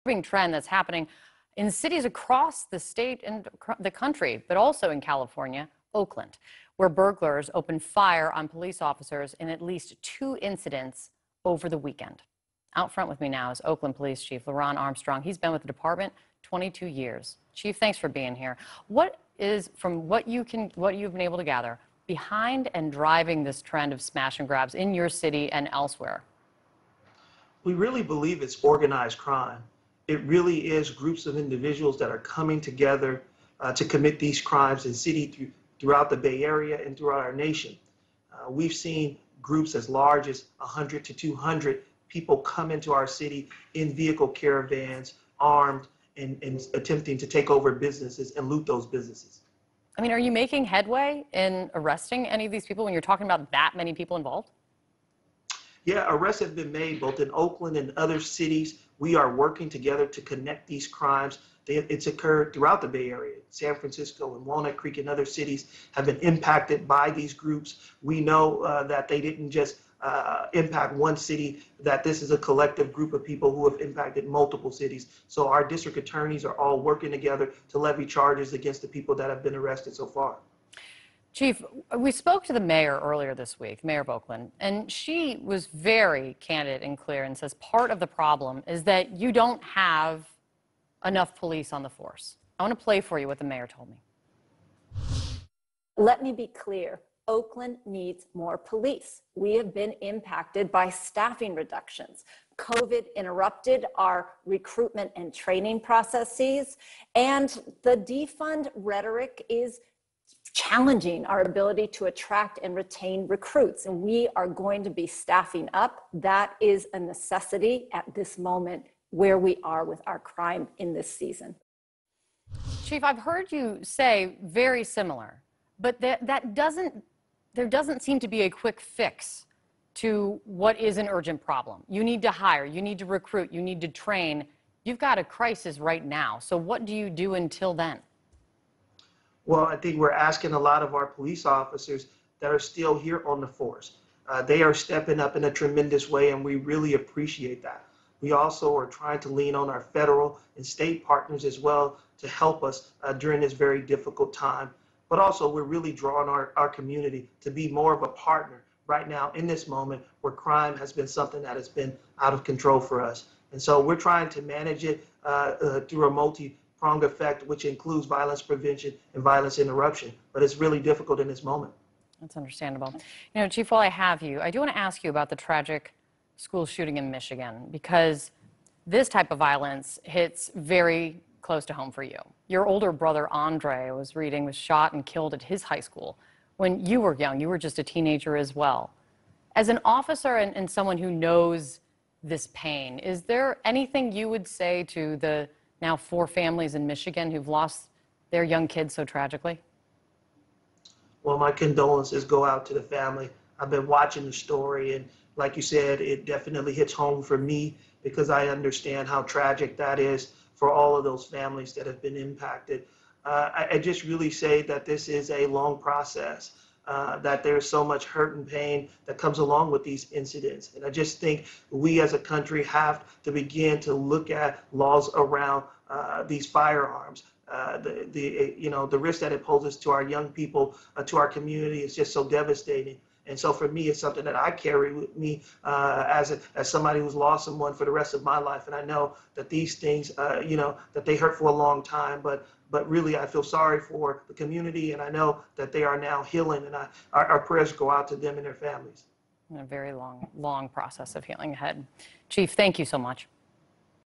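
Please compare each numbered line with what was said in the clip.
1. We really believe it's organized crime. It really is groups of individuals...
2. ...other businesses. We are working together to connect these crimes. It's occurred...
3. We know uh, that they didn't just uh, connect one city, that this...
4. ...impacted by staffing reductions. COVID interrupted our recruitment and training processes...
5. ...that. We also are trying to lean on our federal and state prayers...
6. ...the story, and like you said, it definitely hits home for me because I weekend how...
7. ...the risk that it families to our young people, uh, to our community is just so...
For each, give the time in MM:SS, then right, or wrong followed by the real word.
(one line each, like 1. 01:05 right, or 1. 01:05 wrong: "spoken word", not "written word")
1. 00:27 right
2. 00:57 wrong: "cities", not "businesses"
3. 01:08 wrong: "impact", not "connect"
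4. 01:40 right
5. 02:27 wrong: "partners", not "prayers"
6. 03:24 wrong: "understand", not "weekend"
7. 03:48 wrong: "poses", not "families".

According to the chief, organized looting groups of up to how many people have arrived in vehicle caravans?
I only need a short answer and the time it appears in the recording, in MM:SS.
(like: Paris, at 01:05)
100 to 200, at 00:40.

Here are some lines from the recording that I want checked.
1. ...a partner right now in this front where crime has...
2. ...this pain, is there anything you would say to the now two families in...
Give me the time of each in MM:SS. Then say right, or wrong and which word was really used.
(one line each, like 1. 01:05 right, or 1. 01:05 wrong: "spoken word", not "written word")
1. 02:38 wrong: "moment", not "front"
2. 03:12 wrong: "four", not "two".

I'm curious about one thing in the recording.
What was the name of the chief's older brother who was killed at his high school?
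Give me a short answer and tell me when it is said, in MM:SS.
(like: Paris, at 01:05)
Andre, at 03:03.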